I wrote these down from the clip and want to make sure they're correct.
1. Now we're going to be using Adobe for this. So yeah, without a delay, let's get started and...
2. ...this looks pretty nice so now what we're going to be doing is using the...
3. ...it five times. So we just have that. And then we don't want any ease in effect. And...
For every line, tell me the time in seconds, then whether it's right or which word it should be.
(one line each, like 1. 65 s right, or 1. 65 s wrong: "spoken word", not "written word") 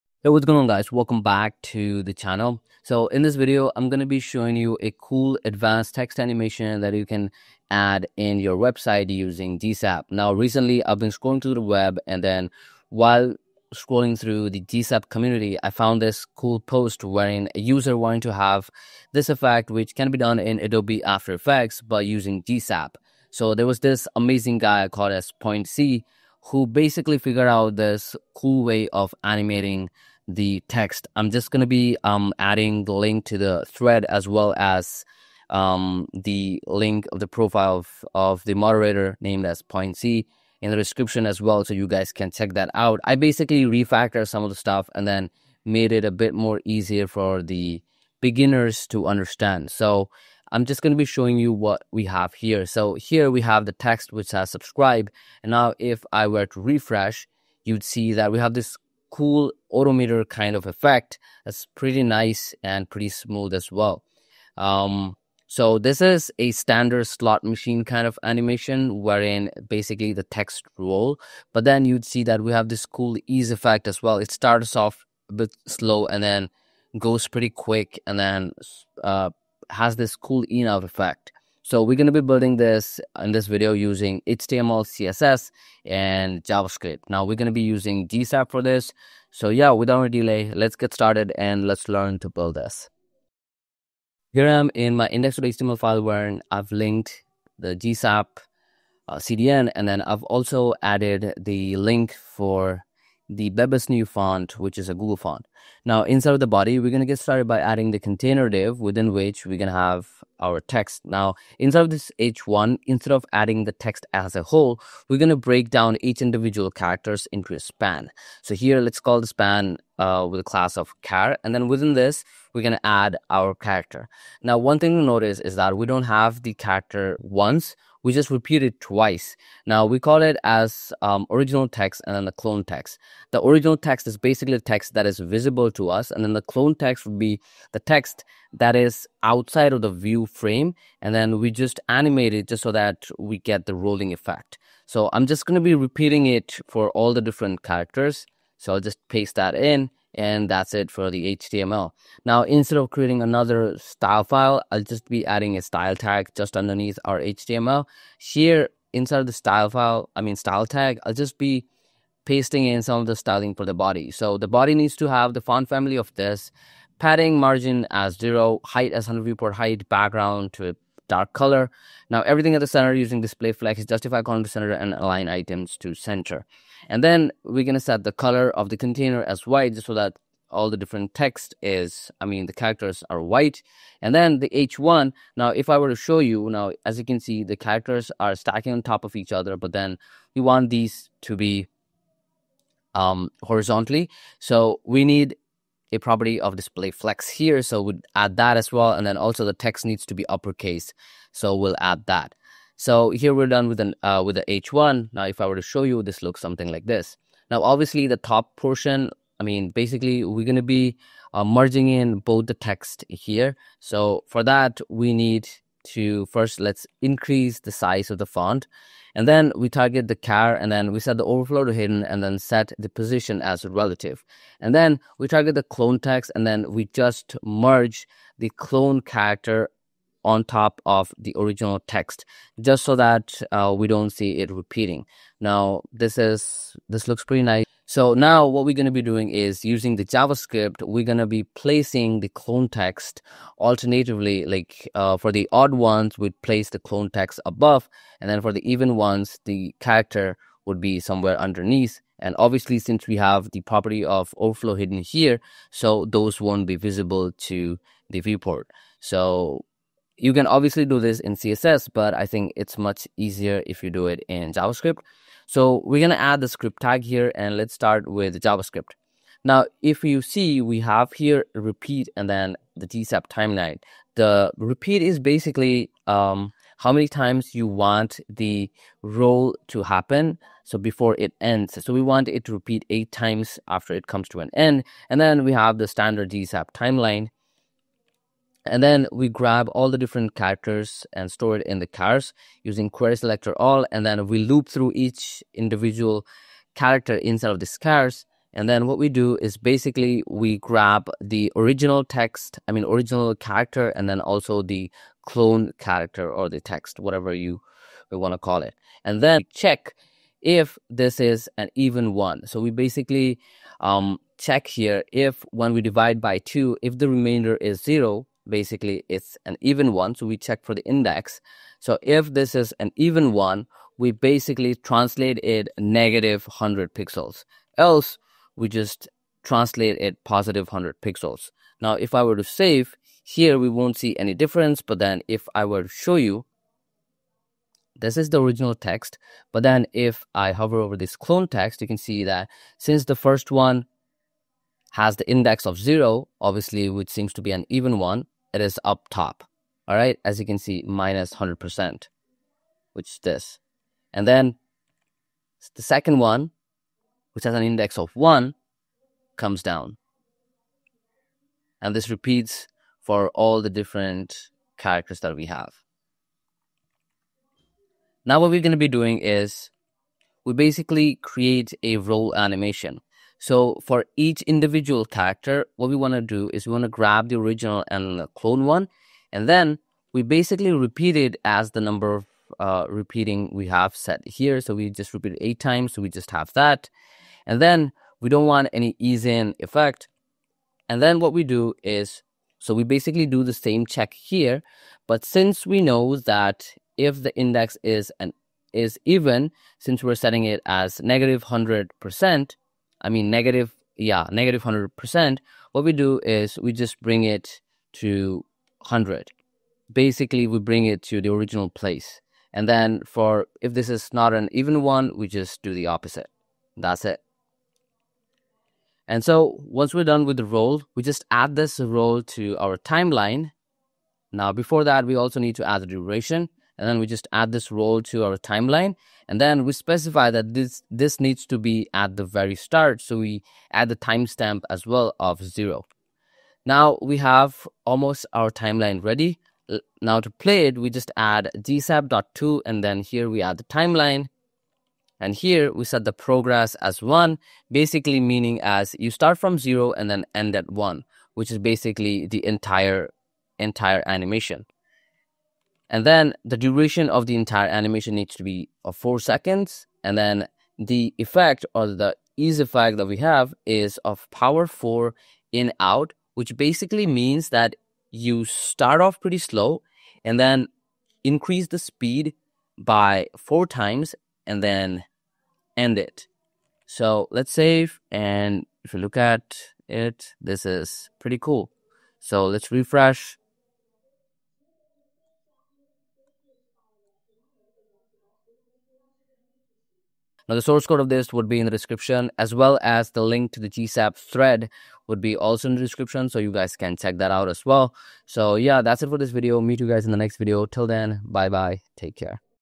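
1. 87 s wrong: "GSAP", not "Adobe"
2. 236 s right
3. 385 s wrong: "eight", not "five".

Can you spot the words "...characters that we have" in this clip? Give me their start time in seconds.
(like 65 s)
364 s.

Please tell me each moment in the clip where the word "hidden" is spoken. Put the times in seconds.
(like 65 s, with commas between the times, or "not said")
221 s, 254 s.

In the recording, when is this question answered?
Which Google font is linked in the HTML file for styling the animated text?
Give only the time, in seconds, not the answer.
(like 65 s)
103 s.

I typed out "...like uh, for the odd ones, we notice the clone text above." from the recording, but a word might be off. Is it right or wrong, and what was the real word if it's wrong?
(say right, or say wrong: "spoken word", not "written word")
wrong: "place", not "notice".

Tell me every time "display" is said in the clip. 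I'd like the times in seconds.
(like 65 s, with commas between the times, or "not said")
173 s, 196 s.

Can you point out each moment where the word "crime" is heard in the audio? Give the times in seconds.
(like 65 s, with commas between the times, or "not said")
not said.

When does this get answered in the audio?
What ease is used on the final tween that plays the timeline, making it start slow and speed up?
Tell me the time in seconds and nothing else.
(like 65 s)
464 s.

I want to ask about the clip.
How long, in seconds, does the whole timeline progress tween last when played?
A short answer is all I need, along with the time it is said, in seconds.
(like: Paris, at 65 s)
4, at 458 s.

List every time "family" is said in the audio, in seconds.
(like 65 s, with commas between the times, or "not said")
165 s.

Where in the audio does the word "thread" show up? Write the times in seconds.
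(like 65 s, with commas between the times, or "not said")
33 s, 494 s.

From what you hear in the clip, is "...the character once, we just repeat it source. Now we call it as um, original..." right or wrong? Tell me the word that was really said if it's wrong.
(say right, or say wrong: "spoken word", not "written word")
wrong: "twice", not "source".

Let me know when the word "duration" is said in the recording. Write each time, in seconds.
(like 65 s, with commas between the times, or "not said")
425 s, 456 s.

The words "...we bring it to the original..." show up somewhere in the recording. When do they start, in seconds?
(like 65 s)
410 s.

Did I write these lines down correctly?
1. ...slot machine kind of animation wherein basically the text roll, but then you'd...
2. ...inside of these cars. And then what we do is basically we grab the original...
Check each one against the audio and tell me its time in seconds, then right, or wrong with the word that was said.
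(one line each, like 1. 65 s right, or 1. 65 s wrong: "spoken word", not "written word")
1. 67 s right
2. 297 s right.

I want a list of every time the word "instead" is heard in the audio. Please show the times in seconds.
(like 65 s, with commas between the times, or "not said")
112 s, 152 s.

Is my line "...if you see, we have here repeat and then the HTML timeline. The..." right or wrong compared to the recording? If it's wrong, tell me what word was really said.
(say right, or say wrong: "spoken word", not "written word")
wrong: "GSAP", not "HTML".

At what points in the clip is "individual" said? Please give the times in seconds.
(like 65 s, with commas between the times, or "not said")
116 s, 295 s, 374 s.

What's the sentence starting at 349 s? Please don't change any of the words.
All right, as you can see, minus 100%, which is this.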